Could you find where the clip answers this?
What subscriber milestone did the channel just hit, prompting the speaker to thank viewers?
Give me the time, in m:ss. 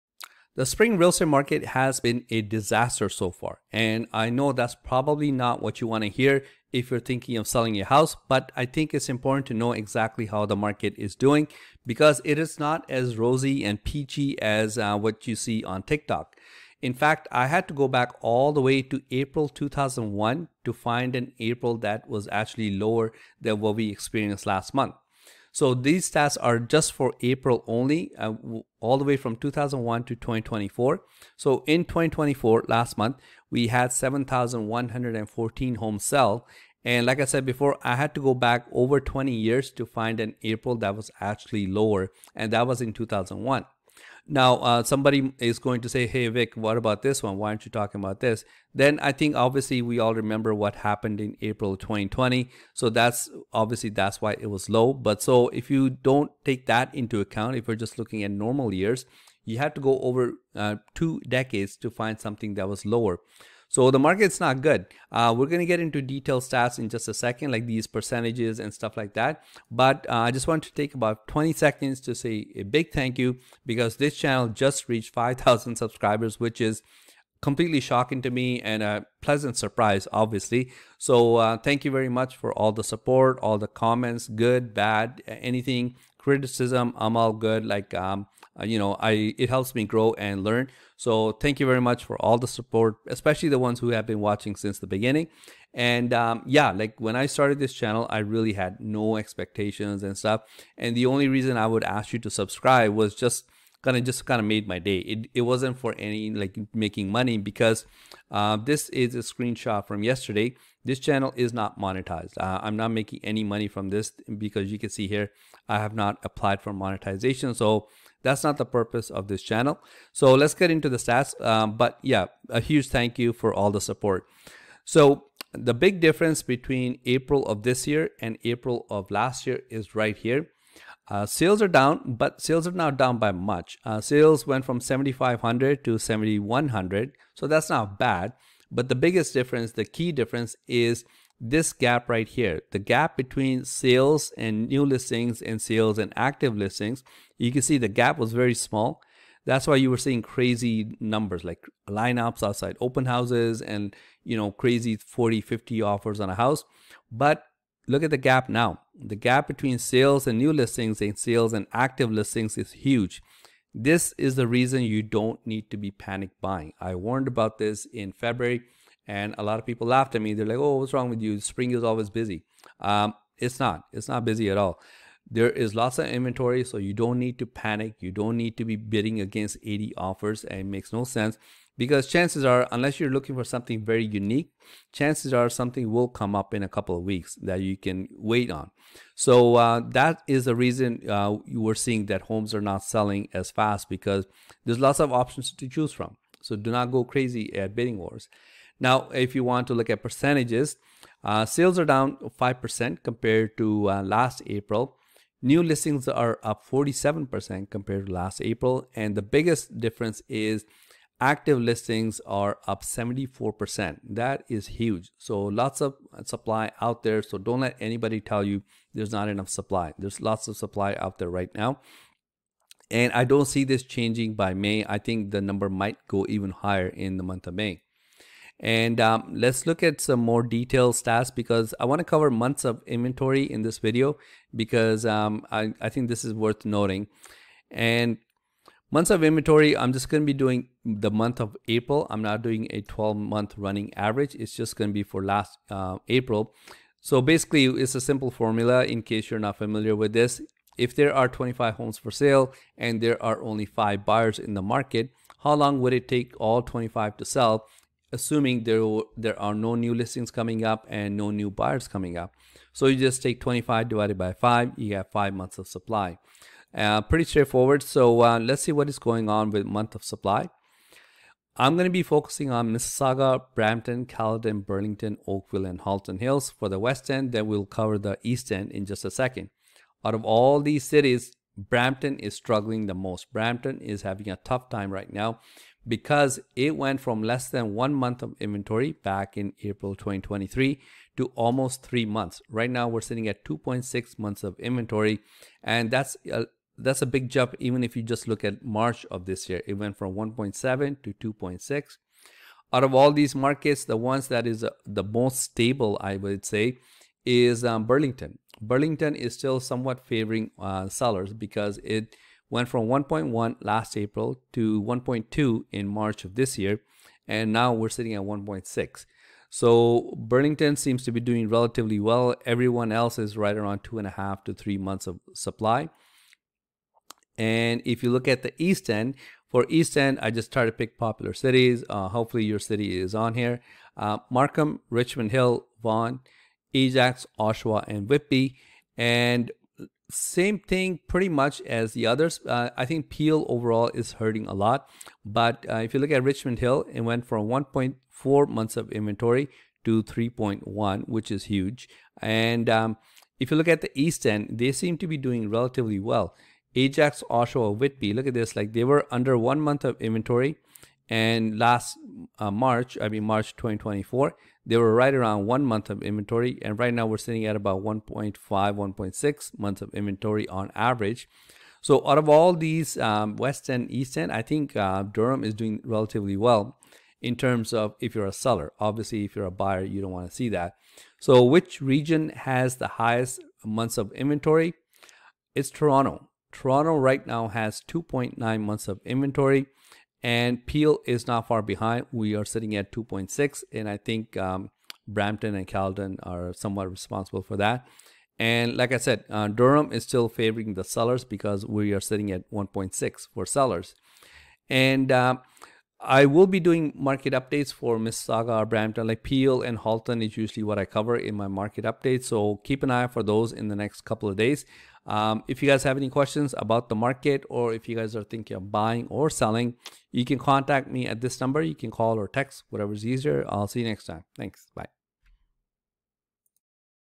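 1:15.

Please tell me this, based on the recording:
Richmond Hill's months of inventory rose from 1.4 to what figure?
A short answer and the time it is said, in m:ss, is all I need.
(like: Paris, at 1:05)
3.1, at 5:50.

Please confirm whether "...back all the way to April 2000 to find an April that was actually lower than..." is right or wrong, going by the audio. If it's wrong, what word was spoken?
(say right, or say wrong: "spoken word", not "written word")
wrong: "2001", not "2000".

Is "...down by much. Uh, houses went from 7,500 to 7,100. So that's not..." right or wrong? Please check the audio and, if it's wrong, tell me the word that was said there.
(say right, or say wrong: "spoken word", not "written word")
wrong: "sales", not "houses".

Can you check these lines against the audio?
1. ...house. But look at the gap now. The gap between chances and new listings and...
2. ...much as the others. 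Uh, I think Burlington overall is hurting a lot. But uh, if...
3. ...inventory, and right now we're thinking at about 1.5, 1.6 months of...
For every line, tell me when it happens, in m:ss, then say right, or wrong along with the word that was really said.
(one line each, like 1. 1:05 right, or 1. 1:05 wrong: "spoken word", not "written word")
1. 2:36 wrong: "sales", not "chances"
2. 5:41 wrong: "Peel", not "Burlington"
3. 6:06 wrong: "sitting", not "thinking".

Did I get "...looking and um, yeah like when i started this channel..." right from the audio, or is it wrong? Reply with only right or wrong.
wrong.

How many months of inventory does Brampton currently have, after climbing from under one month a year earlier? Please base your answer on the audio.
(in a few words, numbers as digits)
2.6.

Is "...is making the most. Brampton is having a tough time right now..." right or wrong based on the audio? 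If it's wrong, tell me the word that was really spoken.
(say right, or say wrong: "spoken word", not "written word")
wrong: "struggling", not "making".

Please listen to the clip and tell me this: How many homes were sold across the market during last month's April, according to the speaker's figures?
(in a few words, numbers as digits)
7,114.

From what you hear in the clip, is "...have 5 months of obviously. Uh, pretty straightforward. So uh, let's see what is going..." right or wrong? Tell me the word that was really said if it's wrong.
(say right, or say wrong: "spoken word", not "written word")
wrong: "supply", not "obviously".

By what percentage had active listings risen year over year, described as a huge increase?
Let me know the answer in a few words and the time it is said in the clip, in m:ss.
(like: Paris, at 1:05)
74%, at 3:32.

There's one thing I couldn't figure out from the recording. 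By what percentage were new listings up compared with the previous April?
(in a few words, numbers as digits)
47%.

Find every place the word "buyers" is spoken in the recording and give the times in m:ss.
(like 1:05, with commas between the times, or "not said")
4:14, 4:21, 6:19.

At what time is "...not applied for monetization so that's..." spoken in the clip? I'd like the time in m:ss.
1:55.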